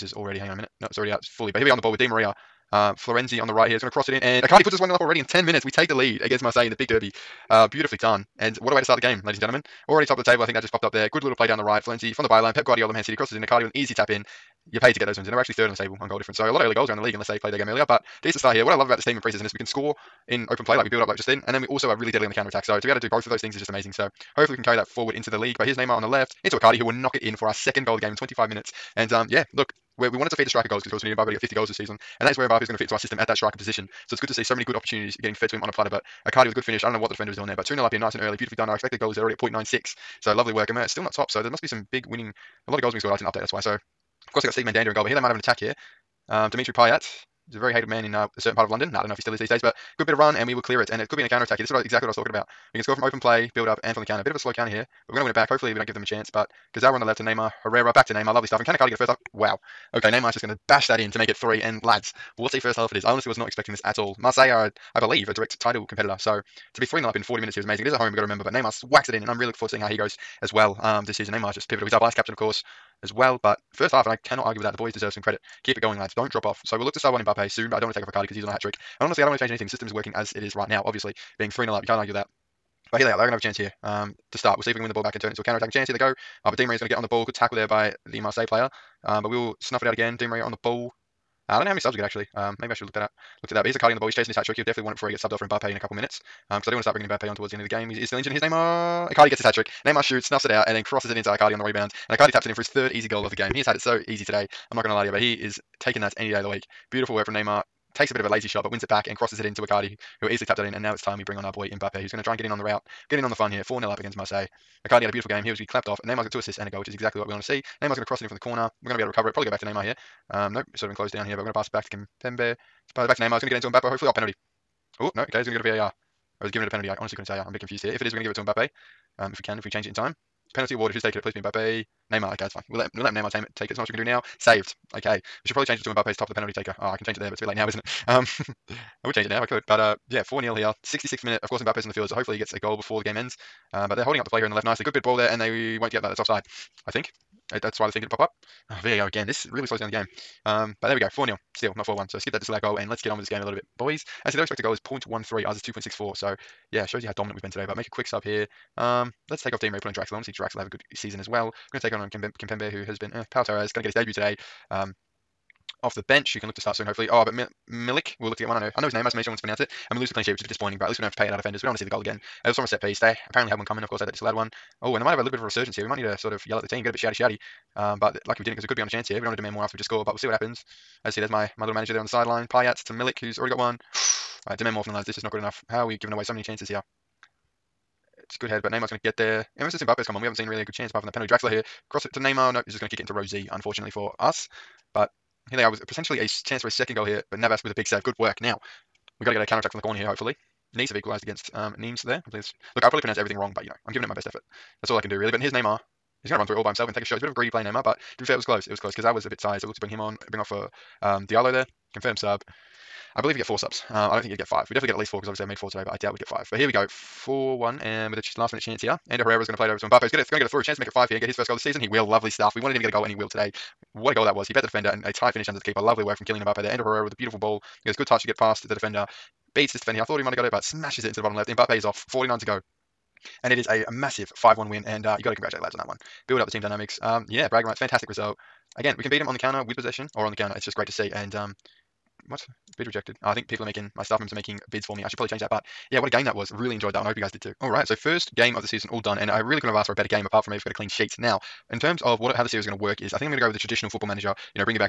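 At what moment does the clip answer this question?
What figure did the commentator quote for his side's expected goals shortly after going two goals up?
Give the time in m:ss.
0:39.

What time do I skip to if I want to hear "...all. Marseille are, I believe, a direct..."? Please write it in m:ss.
1:03.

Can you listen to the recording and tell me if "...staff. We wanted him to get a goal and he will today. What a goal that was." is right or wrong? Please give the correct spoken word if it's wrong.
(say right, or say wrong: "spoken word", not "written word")
wrong: "stuff", not "staff".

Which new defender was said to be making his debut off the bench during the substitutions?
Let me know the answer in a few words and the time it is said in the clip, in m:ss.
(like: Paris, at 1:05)
Pau Torres, at 2:43.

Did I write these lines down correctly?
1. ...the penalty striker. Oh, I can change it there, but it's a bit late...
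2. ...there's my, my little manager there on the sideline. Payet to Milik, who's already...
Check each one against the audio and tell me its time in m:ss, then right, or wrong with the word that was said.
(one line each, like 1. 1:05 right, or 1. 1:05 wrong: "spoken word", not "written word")
1. 2:16 wrong: "taker", not "striker"
2. 3:01 right.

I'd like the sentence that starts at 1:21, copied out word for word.
Being 3 0 up, you can't argue that.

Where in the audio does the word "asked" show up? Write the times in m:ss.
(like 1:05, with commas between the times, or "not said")
4:09.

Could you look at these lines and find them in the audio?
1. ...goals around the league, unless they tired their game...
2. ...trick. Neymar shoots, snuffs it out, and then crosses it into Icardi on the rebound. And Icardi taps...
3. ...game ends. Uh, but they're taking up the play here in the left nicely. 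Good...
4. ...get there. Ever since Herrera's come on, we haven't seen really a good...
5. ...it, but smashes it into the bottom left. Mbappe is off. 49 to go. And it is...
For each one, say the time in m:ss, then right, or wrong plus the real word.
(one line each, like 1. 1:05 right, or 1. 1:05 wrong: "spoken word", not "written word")
1. 0:16 wrong: "played", not "tired"
2. 1:39 right
3. 2:23 wrong: "holding", not "taking"
4. 3:09 wrong: "Mbappe", not "Herrera"
5. 3:50 right.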